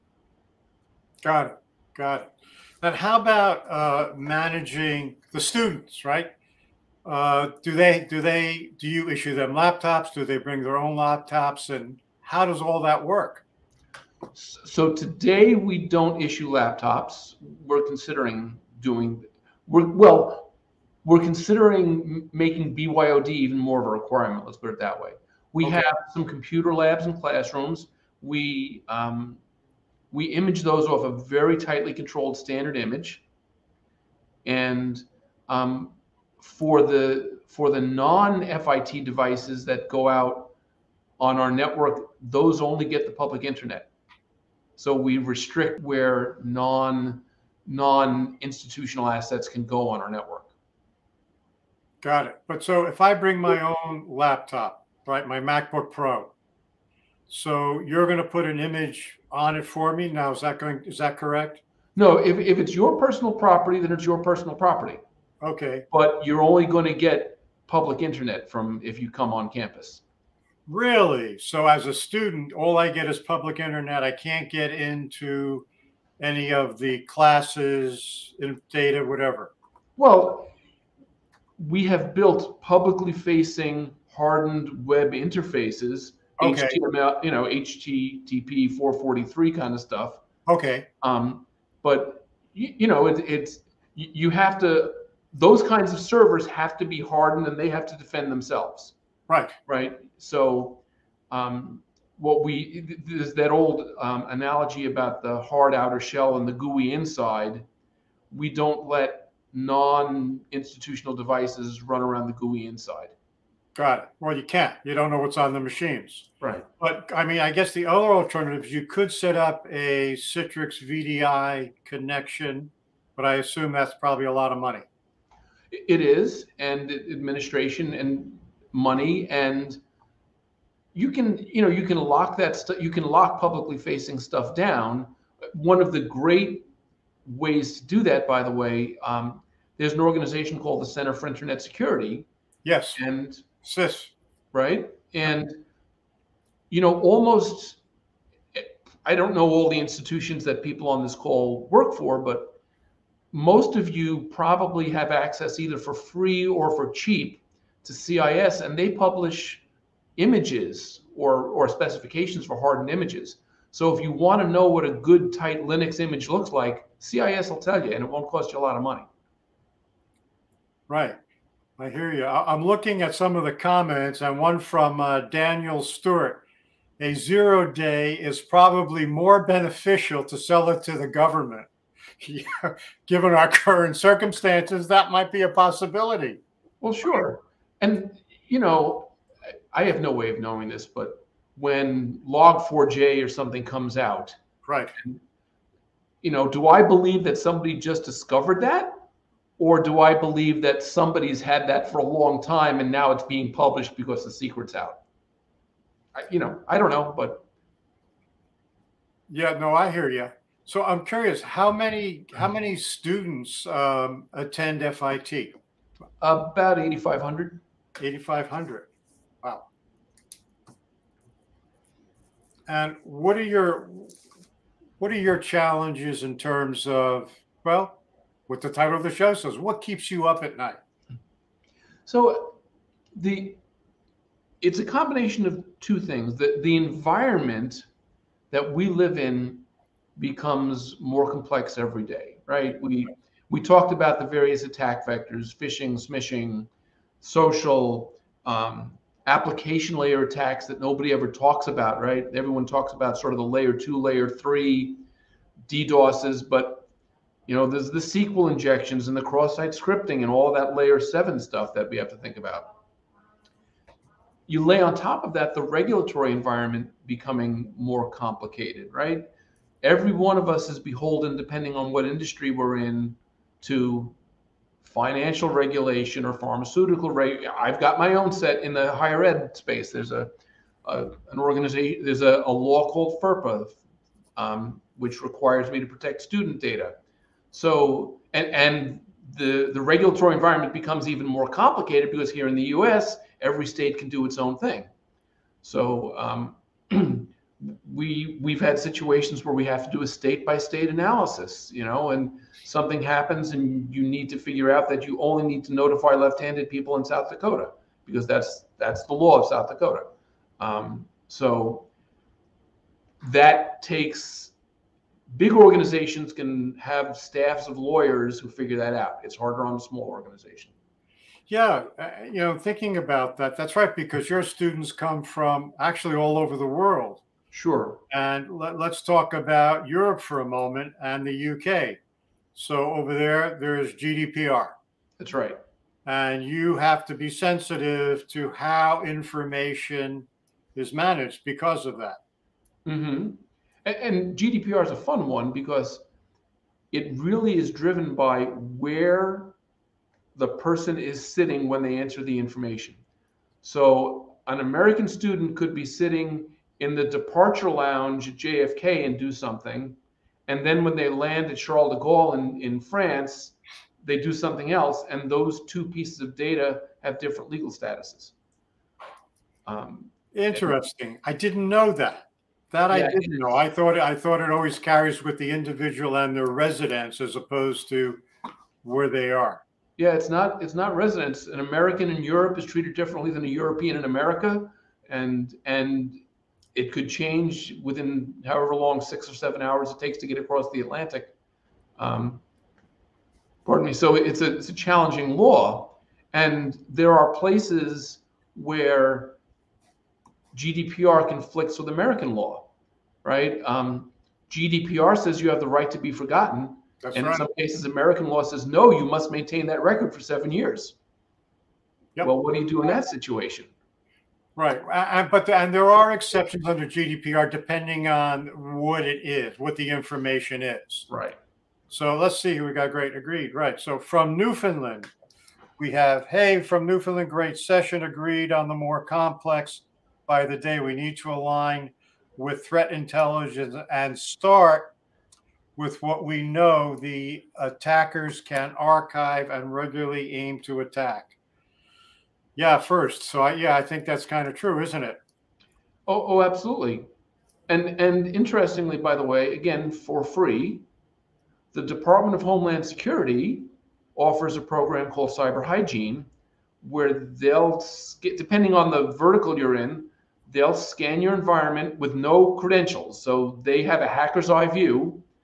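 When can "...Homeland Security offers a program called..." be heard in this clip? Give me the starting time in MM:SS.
07:32.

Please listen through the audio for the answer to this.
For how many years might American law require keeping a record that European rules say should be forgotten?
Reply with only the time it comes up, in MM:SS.
06:50.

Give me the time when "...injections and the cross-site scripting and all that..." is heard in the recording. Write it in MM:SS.
04:18.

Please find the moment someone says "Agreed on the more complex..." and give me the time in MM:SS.
07:08.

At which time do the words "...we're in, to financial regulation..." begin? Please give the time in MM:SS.
04:32.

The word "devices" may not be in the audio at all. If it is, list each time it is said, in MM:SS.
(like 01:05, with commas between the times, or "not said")
00:39, 01:51.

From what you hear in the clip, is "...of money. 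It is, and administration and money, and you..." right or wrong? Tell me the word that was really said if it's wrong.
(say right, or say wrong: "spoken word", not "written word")
right.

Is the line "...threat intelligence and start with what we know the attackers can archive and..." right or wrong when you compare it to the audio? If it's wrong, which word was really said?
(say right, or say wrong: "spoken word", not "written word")
right.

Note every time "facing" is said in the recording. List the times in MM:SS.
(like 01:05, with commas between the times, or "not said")
01:23, 02:13.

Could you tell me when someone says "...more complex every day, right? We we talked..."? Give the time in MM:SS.
04:01.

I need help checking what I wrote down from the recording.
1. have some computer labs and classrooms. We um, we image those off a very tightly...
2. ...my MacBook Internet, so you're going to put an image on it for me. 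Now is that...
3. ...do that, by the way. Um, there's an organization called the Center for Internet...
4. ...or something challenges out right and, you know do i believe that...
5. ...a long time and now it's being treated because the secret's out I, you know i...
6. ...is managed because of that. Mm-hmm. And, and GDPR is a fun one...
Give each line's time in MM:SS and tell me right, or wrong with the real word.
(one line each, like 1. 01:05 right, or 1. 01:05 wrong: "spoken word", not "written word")
1. 00:25 right
2. 00:55 wrong: "Pro", not "Internet"
3. 02:17 right
4. 03:13 wrong: "comes", not "challenges"
5. 03:21 wrong: "published", not "treated"
6. 05:40 right.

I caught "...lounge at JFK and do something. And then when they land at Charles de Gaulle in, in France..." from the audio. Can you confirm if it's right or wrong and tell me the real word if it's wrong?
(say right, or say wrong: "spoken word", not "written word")
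right.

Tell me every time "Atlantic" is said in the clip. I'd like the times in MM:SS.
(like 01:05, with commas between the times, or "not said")
06:30.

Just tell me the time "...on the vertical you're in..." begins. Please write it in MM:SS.
07:38.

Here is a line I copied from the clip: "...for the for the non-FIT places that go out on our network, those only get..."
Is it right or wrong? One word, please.
wrong.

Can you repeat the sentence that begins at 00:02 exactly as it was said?
Now, how about uh, managing the students, right?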